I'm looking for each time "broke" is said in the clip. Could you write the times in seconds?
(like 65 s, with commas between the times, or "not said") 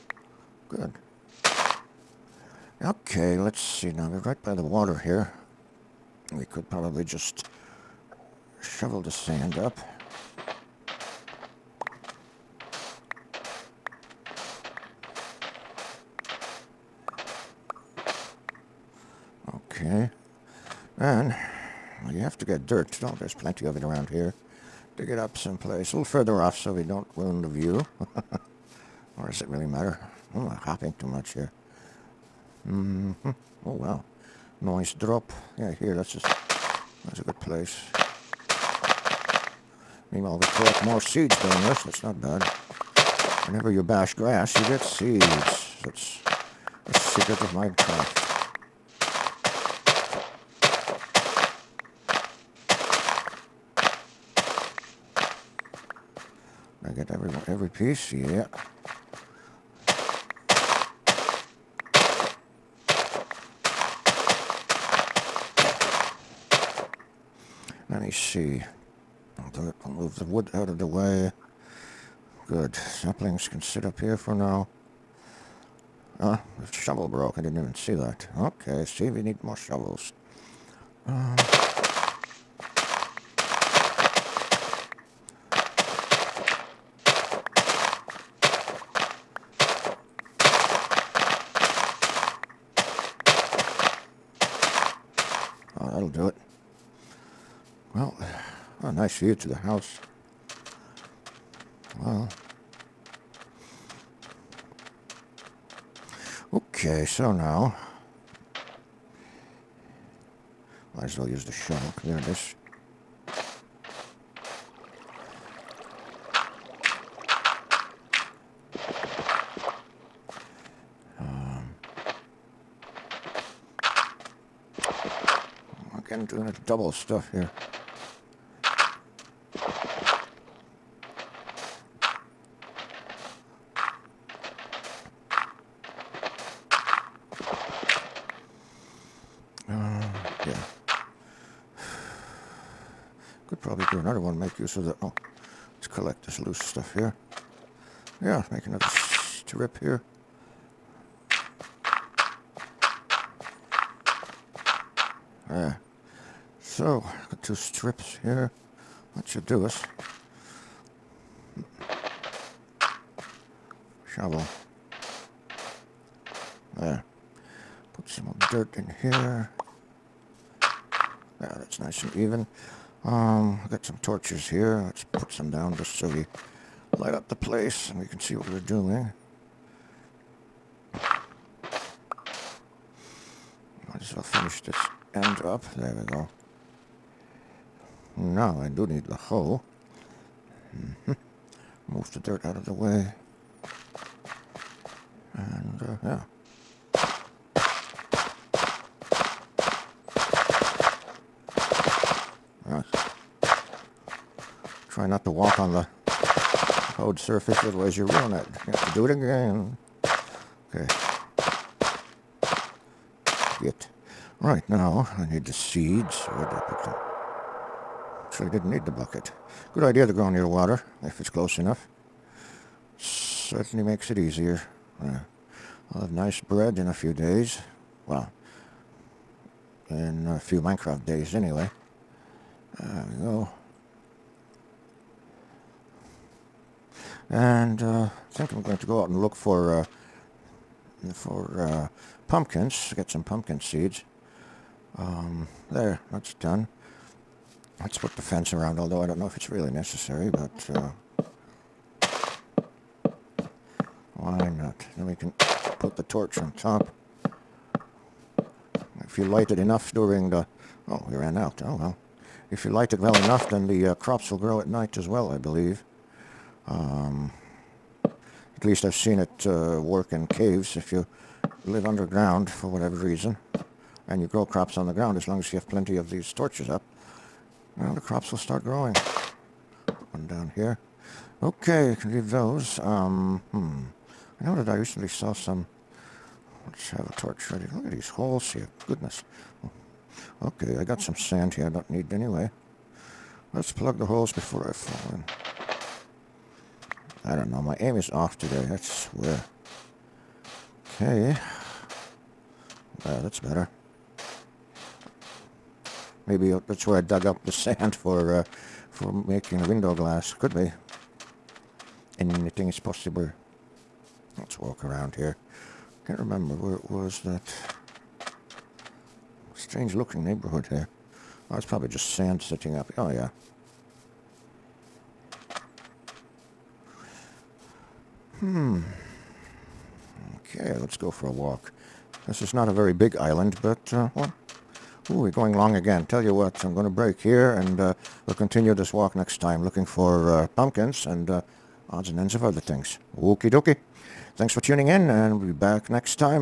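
77 s.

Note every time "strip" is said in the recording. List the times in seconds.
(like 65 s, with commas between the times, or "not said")
148 s, 157 s.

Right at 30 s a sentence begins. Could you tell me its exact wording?
Oh, I'm hopping too much here.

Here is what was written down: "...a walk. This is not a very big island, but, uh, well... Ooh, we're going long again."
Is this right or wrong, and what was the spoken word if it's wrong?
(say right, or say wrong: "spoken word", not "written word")
right.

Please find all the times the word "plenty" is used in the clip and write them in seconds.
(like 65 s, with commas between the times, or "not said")
23 s, 275 s.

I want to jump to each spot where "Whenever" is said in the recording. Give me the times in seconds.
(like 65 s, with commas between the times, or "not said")
43 s.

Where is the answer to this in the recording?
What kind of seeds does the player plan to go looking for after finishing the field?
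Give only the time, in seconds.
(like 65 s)
242 s.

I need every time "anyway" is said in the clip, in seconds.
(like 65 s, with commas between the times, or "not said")
231 s, 292 s.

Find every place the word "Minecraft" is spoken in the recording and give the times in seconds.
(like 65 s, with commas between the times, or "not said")
47 s, 230 s.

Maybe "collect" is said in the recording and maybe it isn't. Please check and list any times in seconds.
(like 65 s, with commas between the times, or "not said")
40 s, 145 s.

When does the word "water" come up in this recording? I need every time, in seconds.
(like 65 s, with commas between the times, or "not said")
4 s, 220 s.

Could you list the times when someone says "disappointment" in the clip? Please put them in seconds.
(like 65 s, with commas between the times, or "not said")
not said.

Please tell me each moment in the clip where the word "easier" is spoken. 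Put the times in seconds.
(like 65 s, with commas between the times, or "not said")
224 s.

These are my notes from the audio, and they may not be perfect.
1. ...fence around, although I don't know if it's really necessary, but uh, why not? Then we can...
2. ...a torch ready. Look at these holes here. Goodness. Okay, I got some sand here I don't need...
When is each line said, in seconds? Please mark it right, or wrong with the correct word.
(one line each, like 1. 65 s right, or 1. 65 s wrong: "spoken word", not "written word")
1. 248 s right
2. 287 s right.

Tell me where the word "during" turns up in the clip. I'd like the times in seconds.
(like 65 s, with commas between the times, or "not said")
41 s, 259 s.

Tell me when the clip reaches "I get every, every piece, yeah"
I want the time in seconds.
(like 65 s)
56 s.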